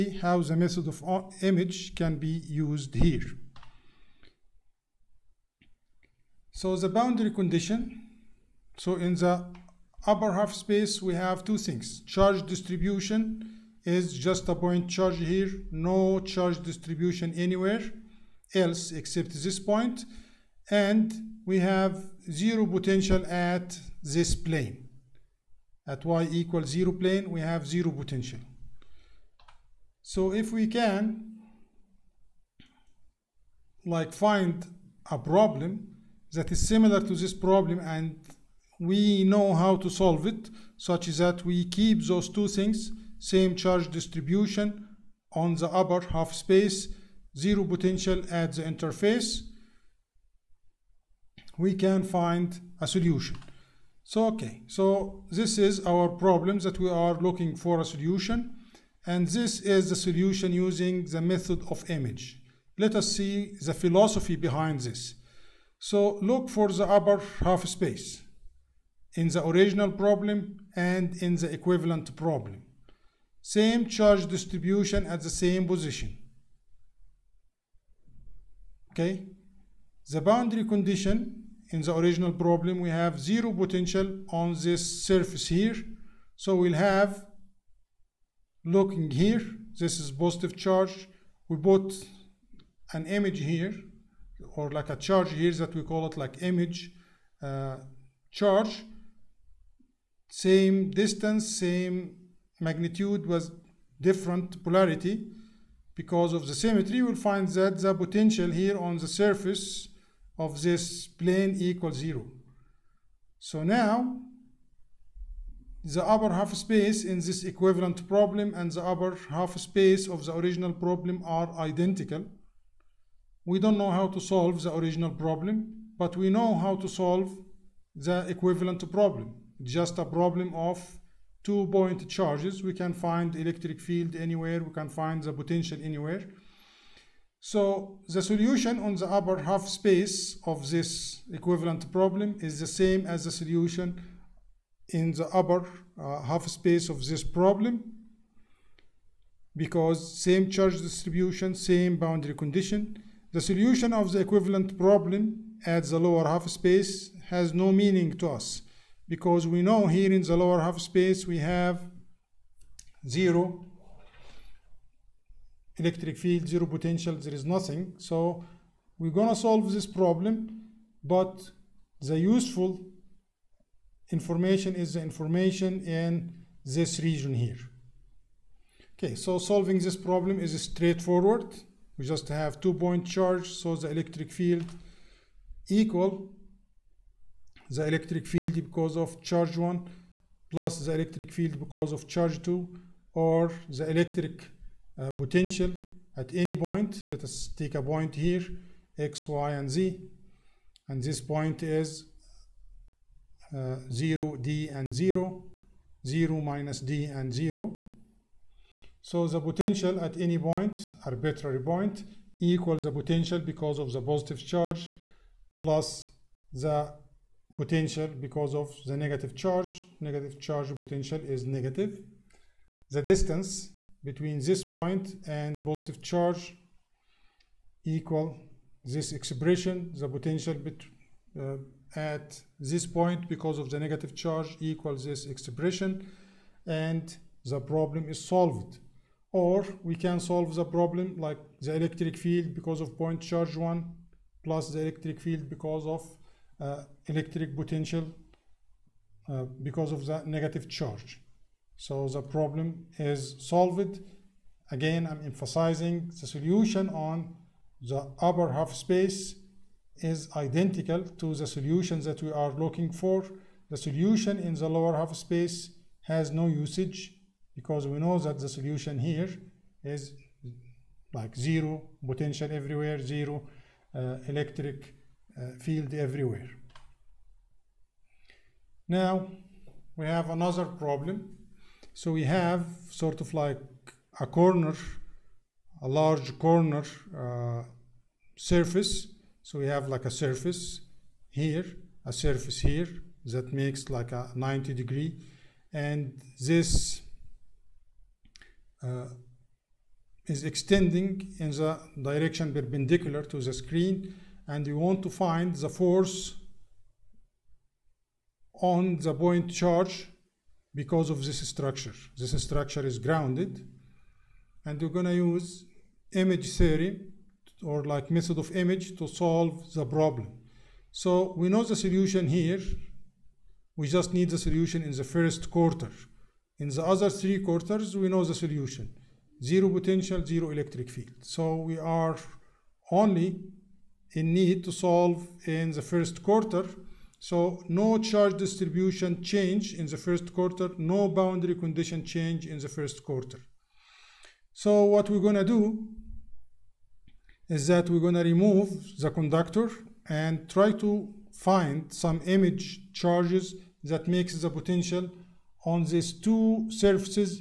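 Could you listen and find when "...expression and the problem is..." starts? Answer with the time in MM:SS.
03:55.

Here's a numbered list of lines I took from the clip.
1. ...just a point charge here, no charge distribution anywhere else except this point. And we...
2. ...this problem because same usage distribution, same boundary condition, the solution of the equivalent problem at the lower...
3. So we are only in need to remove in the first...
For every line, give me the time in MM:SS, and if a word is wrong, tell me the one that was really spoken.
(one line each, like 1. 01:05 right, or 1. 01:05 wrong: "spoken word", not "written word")
1. 00:14 right
2. 02:27 wrong: "charge", not "usage"
3. 05:31 wrong: "solve", not "remove".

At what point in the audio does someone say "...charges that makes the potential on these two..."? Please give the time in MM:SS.
05:52.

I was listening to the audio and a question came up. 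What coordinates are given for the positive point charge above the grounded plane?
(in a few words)
(0, d, 0).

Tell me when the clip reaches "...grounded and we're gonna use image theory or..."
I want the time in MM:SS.
05:12.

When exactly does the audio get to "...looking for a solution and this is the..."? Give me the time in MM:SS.
00:57.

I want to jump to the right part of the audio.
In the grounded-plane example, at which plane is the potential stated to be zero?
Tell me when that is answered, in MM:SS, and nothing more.
00:26.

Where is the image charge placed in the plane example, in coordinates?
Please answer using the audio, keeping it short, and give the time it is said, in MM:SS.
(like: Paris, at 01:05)
(0, -d, 0), at 03:26.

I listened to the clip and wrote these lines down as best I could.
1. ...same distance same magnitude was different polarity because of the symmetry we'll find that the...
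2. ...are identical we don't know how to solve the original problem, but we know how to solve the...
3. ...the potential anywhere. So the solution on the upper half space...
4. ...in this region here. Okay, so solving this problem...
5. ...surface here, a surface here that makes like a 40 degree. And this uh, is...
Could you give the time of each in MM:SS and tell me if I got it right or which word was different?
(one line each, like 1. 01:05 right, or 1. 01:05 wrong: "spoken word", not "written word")
1. 01:40 right
2. 02:01 right
3. 02:15 right
4. 02:55 right
5. 04:50 wrong: "90", not "40".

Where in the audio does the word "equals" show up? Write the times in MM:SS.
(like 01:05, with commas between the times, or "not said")
00:26, 01:51, 03:05, 03:32, 03:47, 03:54.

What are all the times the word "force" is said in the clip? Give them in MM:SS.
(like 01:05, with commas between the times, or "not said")
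05:05.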